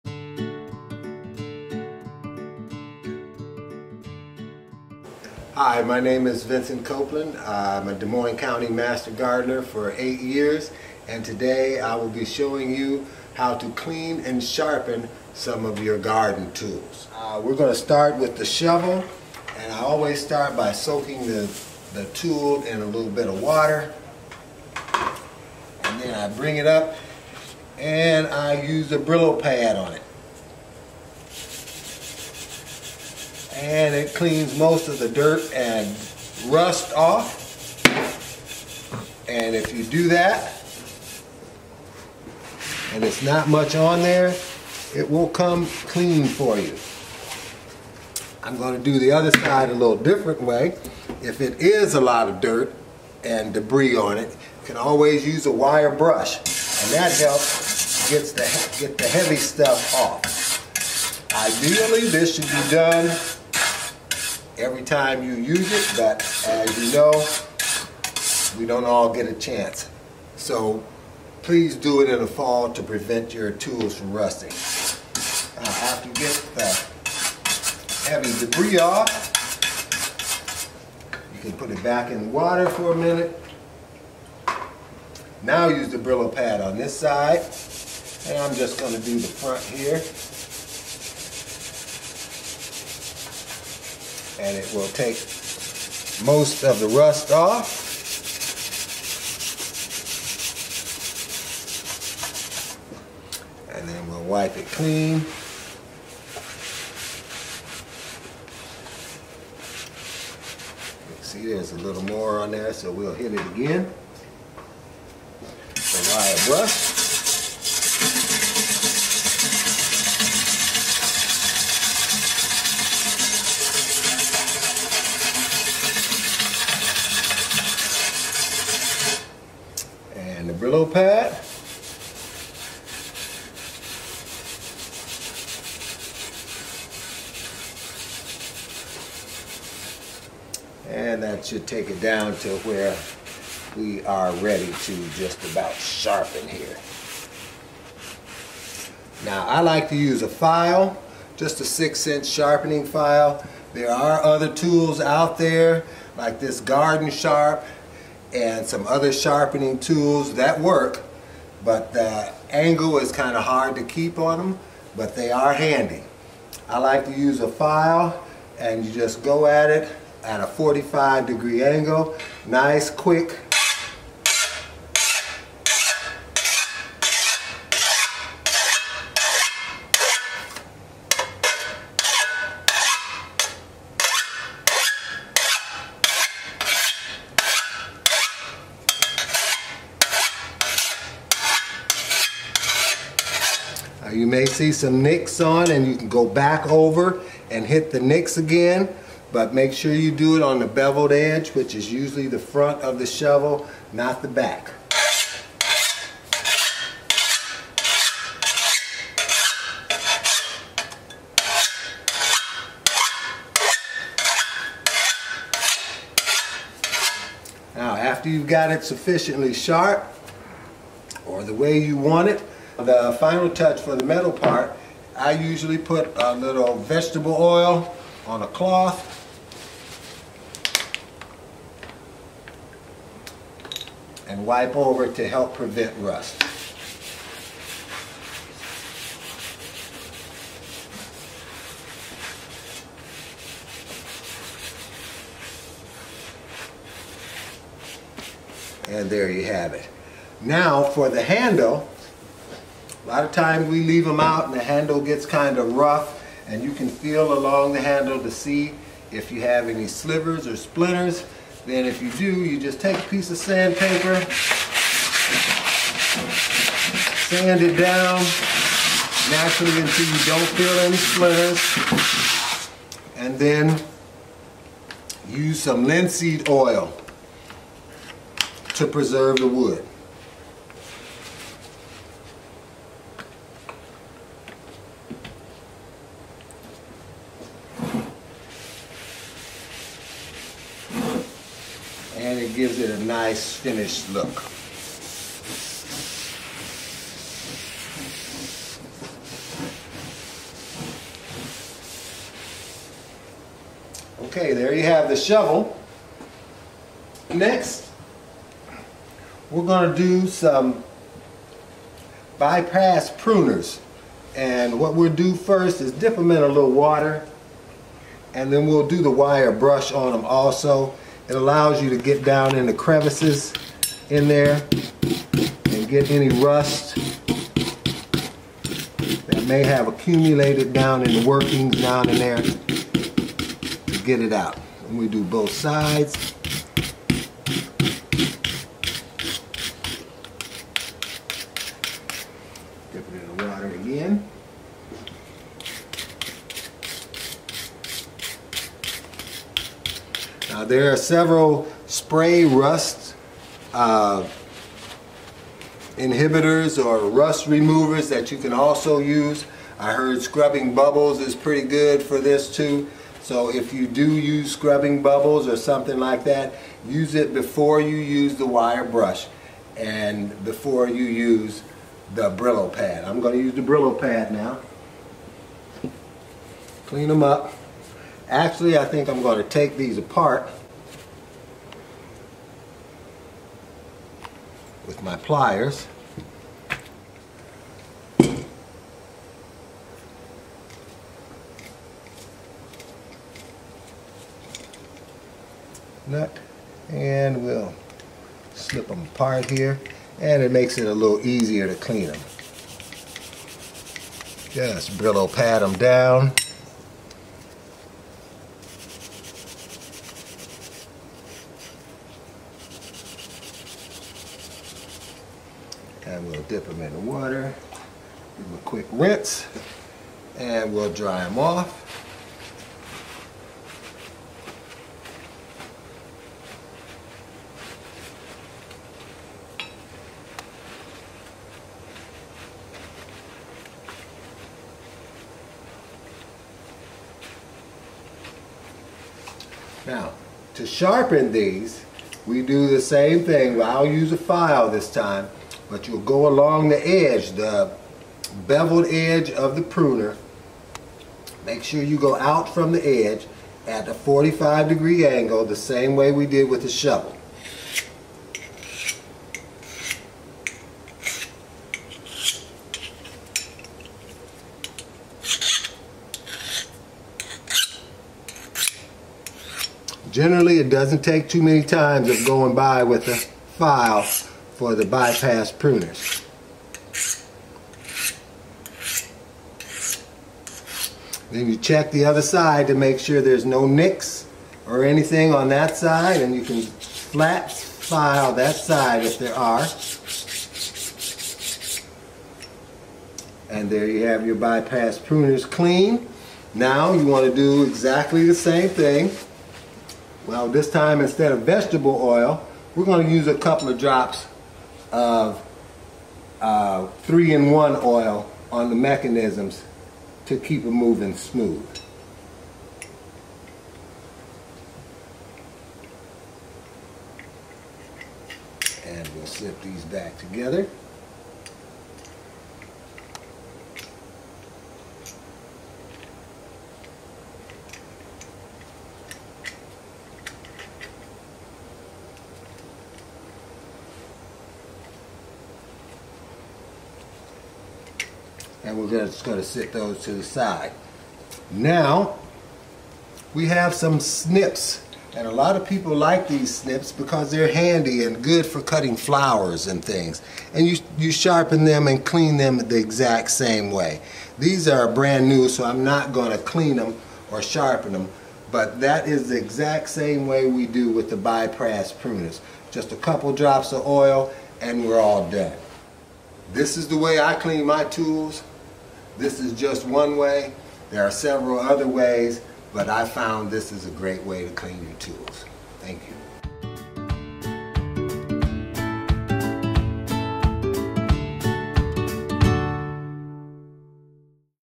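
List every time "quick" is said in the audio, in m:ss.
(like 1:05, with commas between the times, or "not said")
2:52, 6:58.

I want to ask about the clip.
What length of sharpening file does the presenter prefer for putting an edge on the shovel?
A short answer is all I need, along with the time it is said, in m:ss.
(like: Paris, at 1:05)
6 inch, at 2:31.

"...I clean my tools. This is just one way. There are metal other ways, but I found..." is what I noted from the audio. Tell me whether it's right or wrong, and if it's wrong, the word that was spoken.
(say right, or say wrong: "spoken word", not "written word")
wrong: "several", not "metal".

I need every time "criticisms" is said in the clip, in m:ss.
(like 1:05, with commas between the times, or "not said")
not said.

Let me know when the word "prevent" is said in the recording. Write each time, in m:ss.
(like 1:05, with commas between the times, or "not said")
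1:12, 3:55.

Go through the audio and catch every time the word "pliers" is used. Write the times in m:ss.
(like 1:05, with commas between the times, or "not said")
6:25.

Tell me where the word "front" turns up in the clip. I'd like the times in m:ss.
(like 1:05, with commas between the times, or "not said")
1:29, 3:22.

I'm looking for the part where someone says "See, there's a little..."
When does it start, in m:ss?
1:51.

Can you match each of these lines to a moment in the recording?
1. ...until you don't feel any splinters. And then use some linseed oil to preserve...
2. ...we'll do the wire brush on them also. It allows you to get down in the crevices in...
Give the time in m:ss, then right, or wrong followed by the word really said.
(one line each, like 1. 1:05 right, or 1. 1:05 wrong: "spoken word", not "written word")
1. 4:29 right
2. 5:18 right.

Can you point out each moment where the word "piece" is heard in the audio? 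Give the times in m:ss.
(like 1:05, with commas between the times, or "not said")
4:23.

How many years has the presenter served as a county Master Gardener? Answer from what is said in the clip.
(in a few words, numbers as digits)
8.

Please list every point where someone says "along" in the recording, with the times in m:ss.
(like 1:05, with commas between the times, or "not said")
4:17, 7:26.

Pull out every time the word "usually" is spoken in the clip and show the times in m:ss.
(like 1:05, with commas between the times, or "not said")
3:21, 3:45.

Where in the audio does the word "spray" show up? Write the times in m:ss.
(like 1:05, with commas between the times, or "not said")
5:51.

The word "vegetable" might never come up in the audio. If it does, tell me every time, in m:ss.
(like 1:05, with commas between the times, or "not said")
3:46, 8:21.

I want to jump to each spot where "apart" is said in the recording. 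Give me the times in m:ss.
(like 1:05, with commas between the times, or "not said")
6:19, 6:39.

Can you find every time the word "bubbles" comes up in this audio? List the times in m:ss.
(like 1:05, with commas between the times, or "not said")
6:00, 6:05.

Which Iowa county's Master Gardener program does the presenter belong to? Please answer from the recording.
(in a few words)
Des Moines County.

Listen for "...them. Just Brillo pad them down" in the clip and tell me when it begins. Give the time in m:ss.
6:42.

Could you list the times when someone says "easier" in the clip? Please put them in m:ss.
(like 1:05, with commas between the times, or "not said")
6:41.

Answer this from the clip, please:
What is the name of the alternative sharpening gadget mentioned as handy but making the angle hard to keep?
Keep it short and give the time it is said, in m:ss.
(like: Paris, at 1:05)
Garden Sharp, at 2:36.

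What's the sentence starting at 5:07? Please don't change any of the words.
Next, we're going to do some bypass pruners.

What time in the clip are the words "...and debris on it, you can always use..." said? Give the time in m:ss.
0:53.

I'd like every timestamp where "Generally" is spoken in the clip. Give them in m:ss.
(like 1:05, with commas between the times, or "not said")
7:50.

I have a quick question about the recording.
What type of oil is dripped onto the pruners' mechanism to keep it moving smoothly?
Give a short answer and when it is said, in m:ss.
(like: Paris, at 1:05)
3-in-1 oil, at 8:27.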